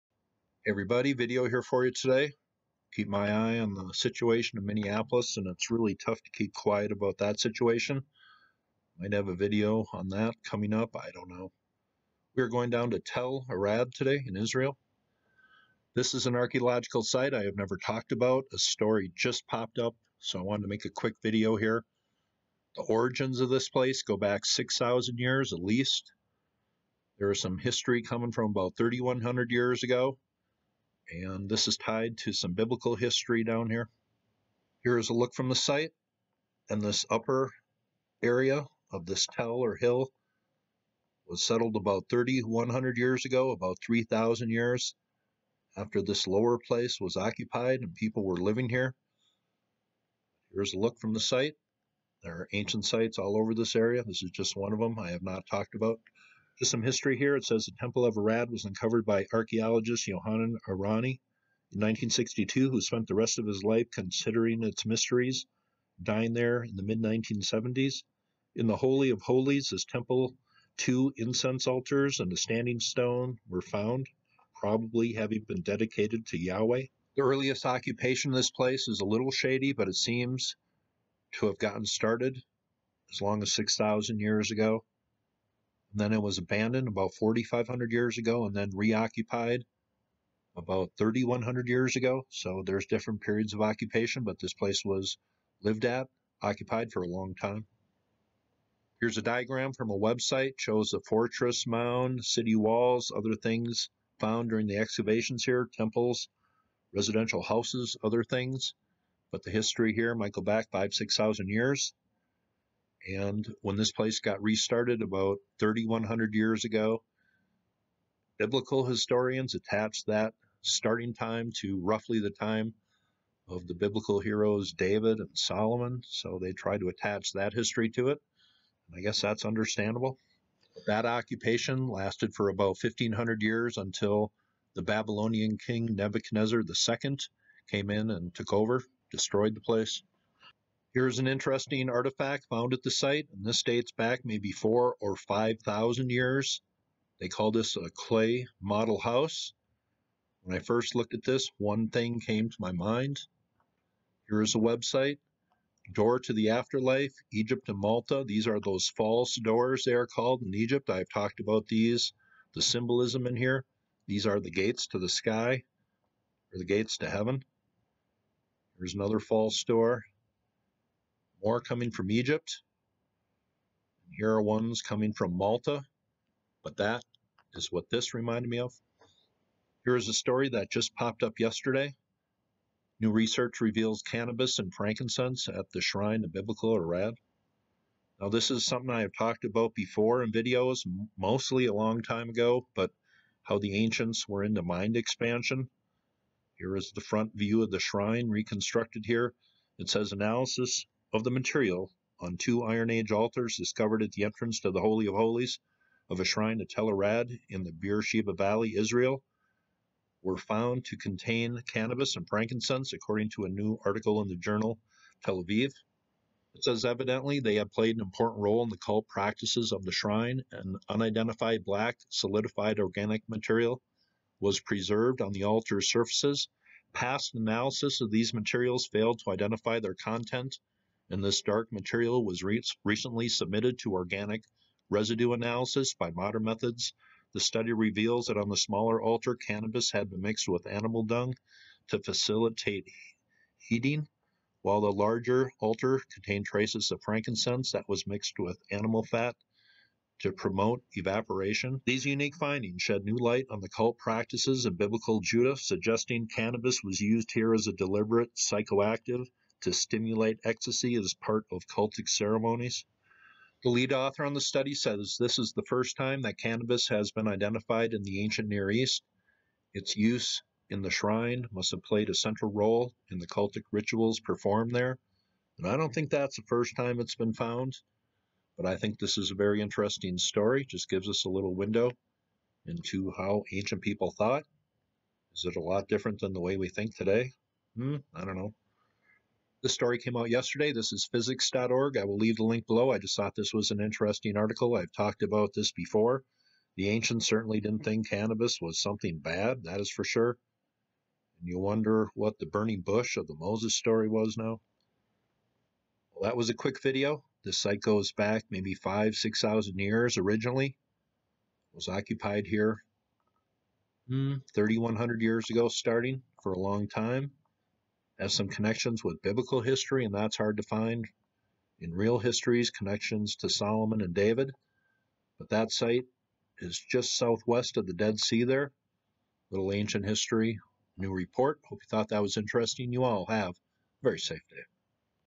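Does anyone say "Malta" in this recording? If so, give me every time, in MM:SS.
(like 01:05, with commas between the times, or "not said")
02:37, 02:55.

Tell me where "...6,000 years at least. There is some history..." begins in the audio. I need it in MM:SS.
00:24.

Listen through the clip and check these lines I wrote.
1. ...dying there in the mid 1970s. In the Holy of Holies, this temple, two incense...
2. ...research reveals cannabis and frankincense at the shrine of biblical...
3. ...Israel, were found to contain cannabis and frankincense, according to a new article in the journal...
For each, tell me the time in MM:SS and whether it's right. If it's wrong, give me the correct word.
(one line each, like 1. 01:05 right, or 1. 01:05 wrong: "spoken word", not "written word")
1. 01:06 right
2. 03:03 right
3. 03:28 right.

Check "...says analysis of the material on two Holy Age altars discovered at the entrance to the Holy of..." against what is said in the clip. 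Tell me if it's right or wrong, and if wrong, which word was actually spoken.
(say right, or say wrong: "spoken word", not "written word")
wrong: "Iron", not "Holy".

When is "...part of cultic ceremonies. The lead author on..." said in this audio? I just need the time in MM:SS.
04:21.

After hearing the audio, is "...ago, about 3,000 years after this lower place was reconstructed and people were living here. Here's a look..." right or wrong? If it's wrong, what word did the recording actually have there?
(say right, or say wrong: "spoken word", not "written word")
wrong: "occupied", not "reconstructed".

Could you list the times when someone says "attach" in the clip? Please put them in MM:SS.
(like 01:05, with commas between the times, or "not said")
01:59, 02:06.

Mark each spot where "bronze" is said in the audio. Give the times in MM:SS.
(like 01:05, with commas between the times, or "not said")
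not said.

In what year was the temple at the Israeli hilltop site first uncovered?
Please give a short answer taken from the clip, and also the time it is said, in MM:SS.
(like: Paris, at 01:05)
1962, at 01:01.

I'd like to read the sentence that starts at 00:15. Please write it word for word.
This is an archaeological site I have never talked about.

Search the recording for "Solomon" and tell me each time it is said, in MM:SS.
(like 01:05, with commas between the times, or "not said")
02:05, 05:23.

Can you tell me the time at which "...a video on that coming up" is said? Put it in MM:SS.
00:09.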